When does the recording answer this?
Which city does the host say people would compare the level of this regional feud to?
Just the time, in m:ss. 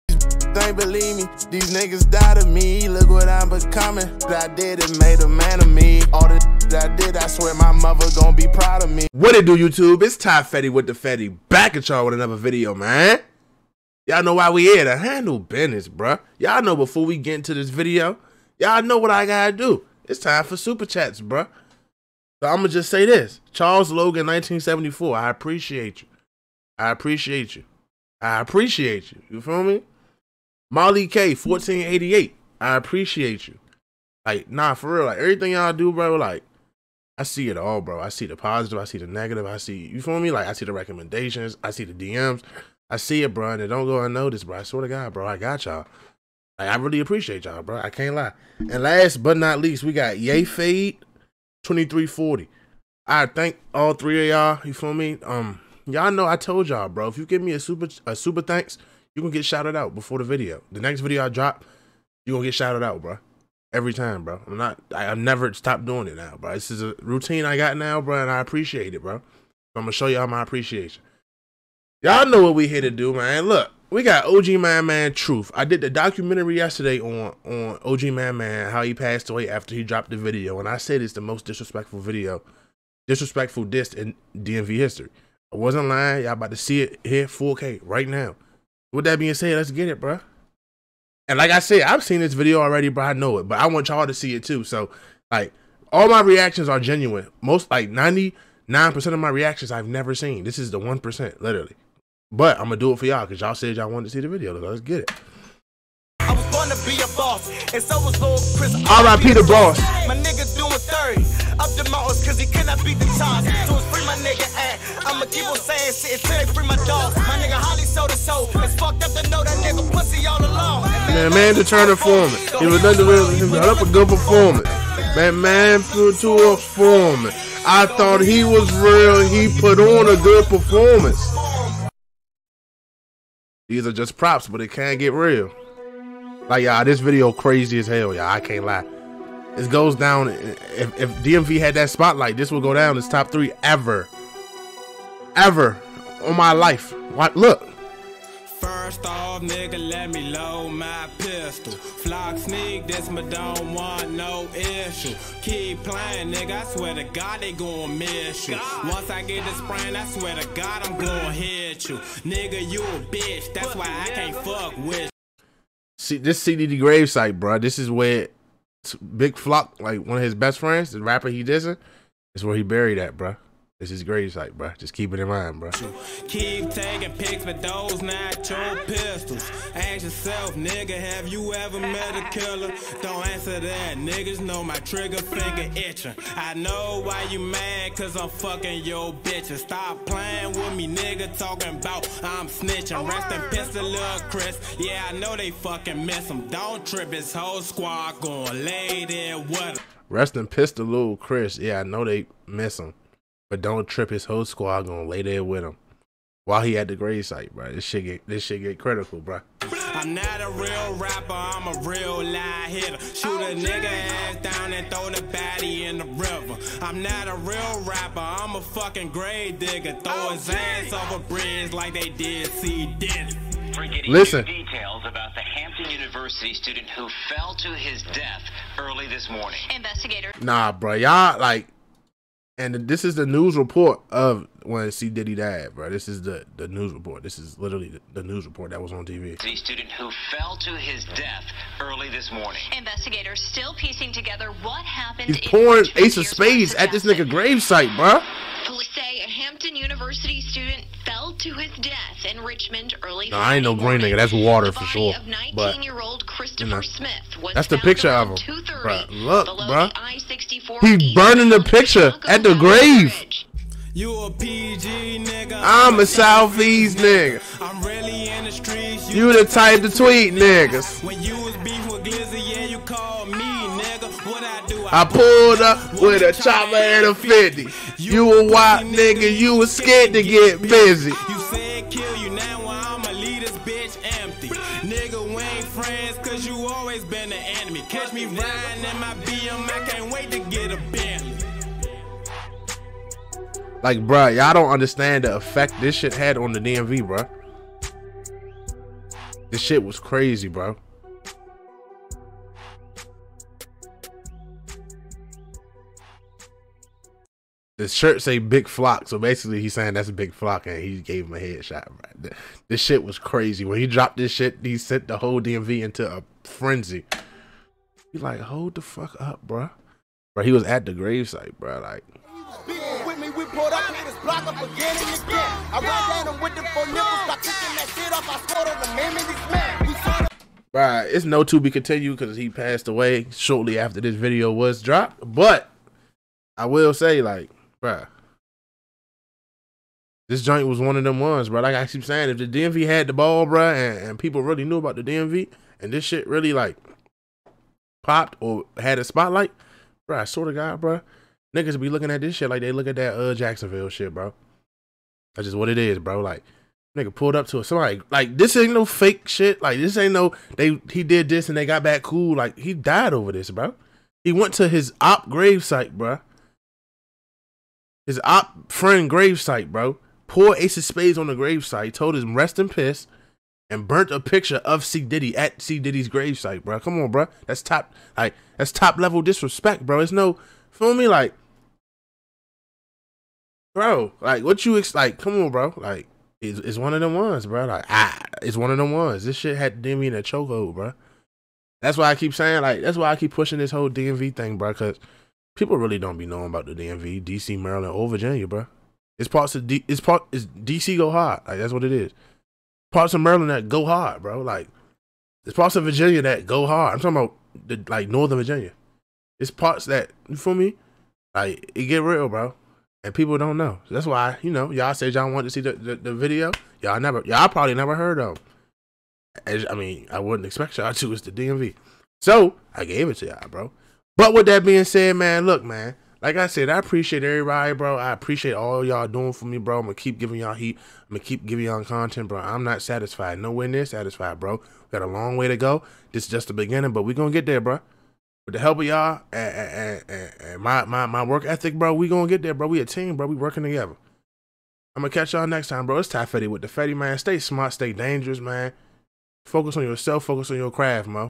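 5:53.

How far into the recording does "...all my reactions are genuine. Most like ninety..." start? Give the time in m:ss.
1:35.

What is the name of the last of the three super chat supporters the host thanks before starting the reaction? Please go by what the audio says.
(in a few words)
Yay Fade 2340.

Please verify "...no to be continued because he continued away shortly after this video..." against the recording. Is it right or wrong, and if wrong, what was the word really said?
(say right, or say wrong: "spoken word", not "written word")
wrong: "passed", not "continued".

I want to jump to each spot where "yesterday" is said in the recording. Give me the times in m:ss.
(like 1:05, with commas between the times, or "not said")
1:16.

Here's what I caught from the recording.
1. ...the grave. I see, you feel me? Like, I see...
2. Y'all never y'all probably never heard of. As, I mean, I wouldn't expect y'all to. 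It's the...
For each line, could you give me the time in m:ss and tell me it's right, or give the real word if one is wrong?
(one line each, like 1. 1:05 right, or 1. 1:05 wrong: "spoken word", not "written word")
1. 0:38 wrong: "negative", not "grave"
2. 6:56 right.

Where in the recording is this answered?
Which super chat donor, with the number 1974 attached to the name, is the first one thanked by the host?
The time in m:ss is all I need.
0:23.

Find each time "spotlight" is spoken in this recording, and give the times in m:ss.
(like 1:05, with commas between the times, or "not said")
2:21, 5:49.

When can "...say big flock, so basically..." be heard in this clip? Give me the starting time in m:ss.
5:08.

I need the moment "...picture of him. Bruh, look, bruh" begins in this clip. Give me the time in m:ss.
4:17.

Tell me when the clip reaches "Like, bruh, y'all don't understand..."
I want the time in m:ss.
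4:53.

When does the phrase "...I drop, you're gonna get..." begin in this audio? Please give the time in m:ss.
1:01.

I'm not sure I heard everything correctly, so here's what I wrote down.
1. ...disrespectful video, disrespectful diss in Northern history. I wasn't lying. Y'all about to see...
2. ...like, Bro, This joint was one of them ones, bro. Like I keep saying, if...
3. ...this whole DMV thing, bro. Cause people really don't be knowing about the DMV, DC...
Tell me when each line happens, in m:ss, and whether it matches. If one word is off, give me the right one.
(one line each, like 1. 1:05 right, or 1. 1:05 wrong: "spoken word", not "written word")
1. 1:21 wrong: "DMV", not "Northern"
2. 5:37 right
3. 6:33 right.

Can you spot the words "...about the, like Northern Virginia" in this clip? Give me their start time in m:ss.
6:47.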